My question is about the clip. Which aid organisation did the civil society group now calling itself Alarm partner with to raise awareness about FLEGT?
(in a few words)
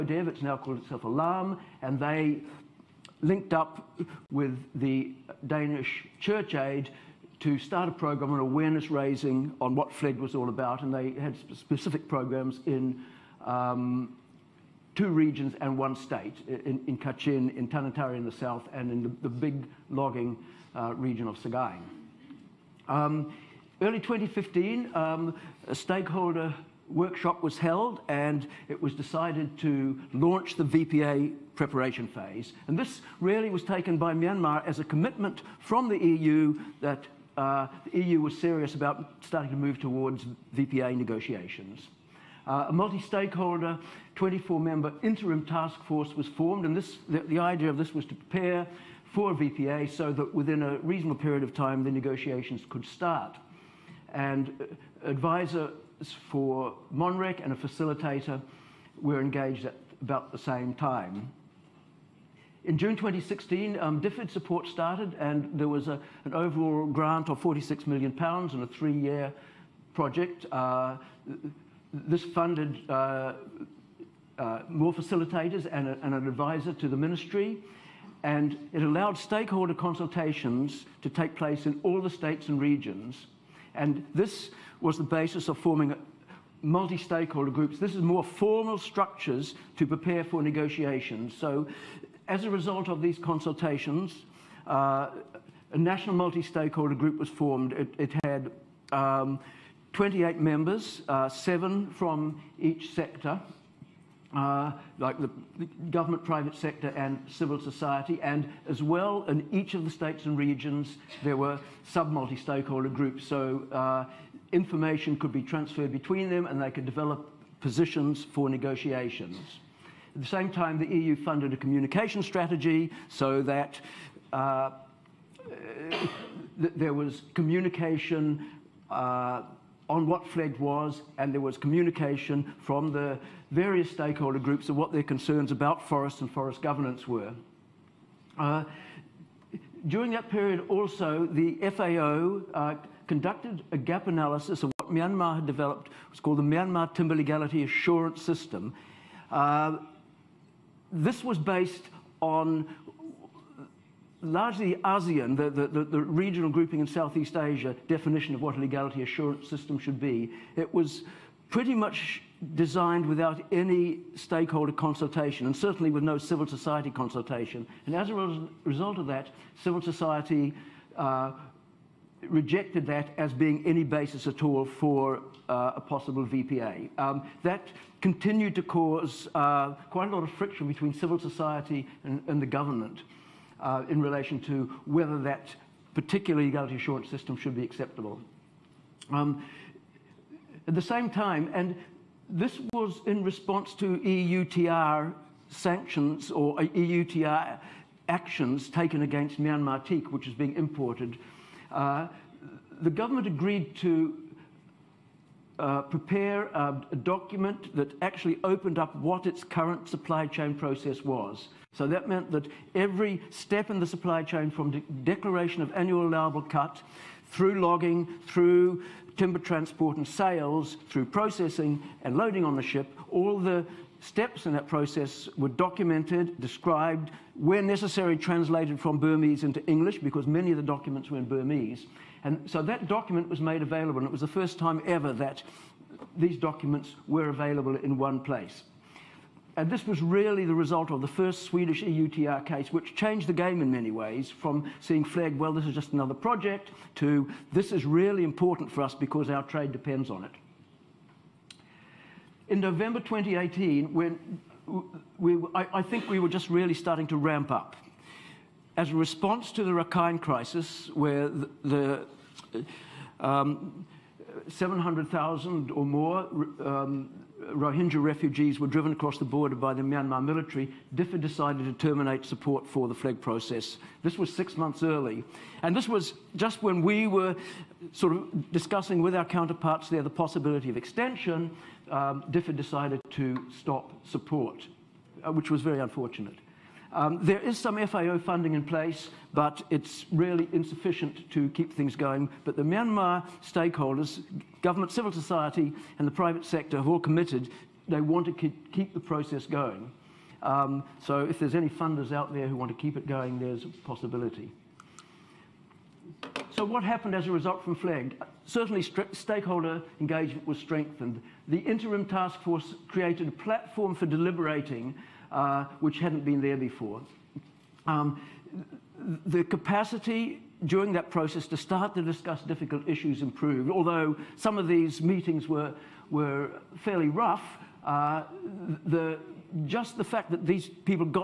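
Danish Church Aid.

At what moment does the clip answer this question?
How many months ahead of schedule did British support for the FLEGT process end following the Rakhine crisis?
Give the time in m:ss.
4:34.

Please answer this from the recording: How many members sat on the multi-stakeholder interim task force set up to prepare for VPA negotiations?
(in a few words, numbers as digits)
24.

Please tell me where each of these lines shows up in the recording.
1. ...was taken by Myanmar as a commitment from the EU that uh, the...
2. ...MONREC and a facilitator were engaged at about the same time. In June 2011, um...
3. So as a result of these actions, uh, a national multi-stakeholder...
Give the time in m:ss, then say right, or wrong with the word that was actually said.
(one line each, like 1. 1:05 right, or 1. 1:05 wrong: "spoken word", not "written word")
1. 0:33 right
2. 0:56 wrong: "2016", not "2011"
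3. 1:31 wrong: "consultations", not "actions".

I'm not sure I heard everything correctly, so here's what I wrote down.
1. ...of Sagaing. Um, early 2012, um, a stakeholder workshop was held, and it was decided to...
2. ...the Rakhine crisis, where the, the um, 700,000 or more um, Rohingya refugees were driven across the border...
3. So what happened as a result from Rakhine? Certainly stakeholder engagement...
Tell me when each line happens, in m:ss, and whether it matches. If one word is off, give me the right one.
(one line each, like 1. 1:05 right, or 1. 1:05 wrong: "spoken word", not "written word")
1. 0:21 wrong: "2015", not "2012"
2. 4:19 right
3. 5:06 wrong: "FLEGT", not "Rakhine".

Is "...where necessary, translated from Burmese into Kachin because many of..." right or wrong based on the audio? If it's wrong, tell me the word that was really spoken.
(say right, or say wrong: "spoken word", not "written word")
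wrong: "English", not "Kachin".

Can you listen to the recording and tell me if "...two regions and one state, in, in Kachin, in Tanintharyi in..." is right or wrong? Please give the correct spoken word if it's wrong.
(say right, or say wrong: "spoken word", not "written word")
right.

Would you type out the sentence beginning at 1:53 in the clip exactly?
So uh, information could be transferred between them, and they could develop positions for negotiations.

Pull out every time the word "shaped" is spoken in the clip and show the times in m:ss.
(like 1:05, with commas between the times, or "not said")
not said.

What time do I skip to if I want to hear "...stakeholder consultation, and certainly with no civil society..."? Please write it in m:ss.
2:44.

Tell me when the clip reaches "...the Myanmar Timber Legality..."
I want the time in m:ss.
2:26.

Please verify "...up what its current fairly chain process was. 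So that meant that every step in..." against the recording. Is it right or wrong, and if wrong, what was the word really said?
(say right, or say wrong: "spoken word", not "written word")
wrong: "supply", not "fairly".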